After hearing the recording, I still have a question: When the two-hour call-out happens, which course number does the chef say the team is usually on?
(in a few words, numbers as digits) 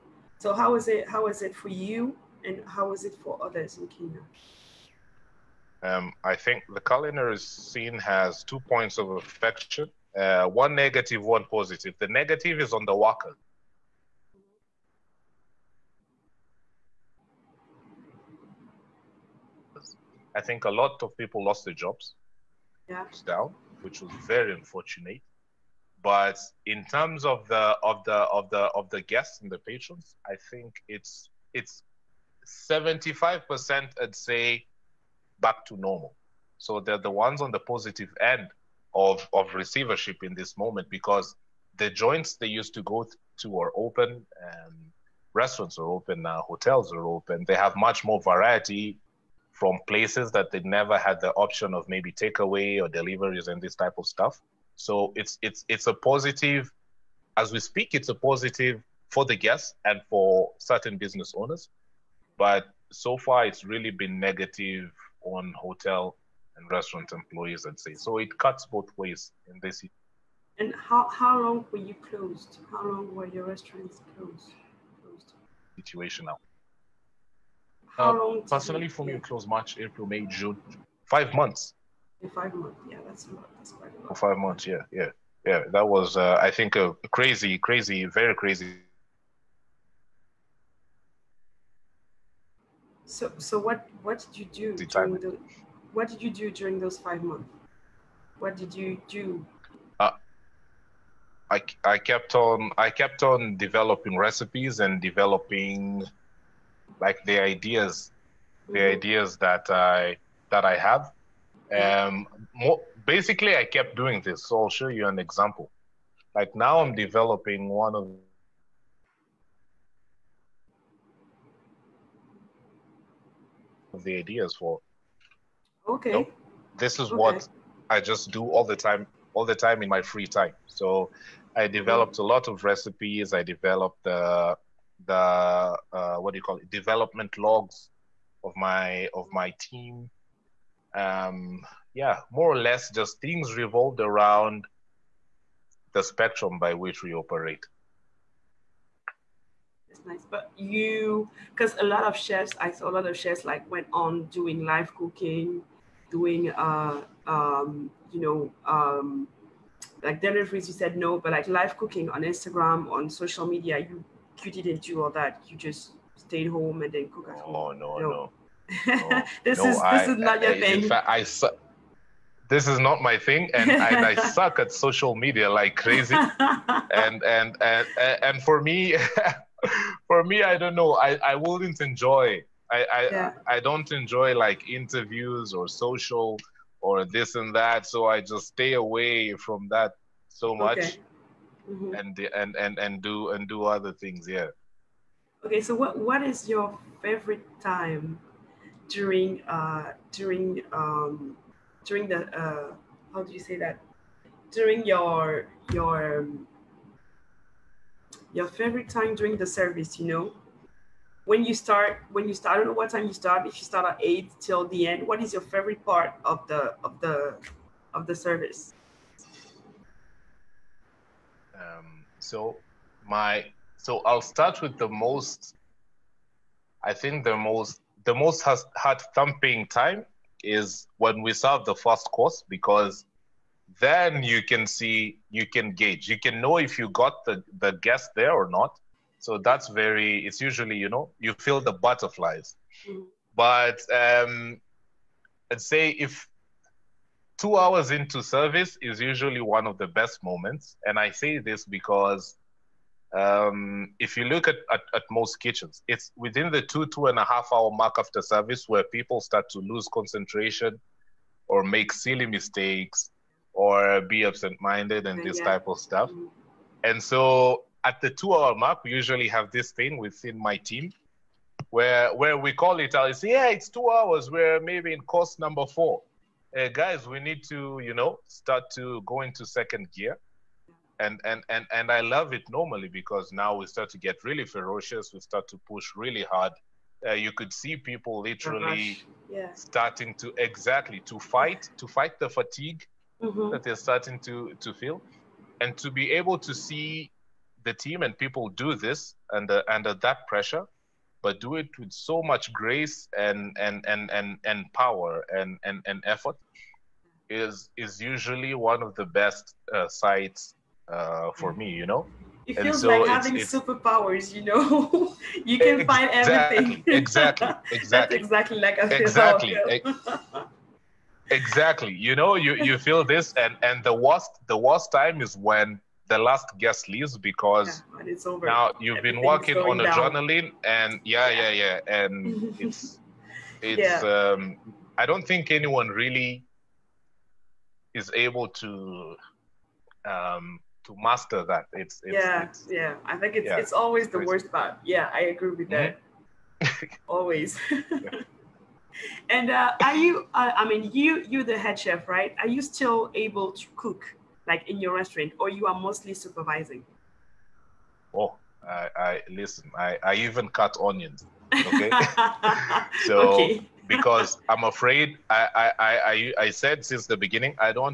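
4.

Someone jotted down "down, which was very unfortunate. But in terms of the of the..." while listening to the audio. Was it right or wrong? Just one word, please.
right.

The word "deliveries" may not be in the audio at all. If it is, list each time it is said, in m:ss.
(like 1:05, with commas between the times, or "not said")
0:52, 2:40.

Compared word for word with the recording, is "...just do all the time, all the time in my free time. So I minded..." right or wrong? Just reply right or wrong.
wrong.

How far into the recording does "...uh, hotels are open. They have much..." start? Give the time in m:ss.
0:46.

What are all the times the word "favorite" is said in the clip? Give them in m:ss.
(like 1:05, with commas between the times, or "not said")
3:17, 3:28, 3:35.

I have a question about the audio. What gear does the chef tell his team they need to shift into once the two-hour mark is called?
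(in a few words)
second gear.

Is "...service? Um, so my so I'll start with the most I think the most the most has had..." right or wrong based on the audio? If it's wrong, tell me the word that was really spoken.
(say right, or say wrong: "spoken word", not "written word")
right.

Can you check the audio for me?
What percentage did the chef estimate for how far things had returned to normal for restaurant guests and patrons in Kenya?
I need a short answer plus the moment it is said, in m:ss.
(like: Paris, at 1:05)
75%, at 0:32.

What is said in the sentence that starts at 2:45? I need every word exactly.
You just stayed home and then cook at home.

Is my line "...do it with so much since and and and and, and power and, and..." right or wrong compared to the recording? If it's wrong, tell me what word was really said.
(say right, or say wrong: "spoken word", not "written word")
wrong: "grace", not "since".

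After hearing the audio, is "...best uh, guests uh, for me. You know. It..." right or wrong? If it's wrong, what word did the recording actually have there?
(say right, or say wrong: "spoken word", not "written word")
wrong: "sights", not "guests".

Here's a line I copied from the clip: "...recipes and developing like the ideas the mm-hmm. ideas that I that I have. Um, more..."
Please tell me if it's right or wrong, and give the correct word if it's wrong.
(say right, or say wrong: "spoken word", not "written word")
right.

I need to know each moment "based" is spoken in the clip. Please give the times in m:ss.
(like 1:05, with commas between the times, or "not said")
not said.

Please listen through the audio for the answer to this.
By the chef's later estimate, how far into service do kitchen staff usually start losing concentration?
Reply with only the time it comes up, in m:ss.
4:16.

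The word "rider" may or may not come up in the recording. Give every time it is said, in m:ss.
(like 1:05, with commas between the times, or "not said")
not said.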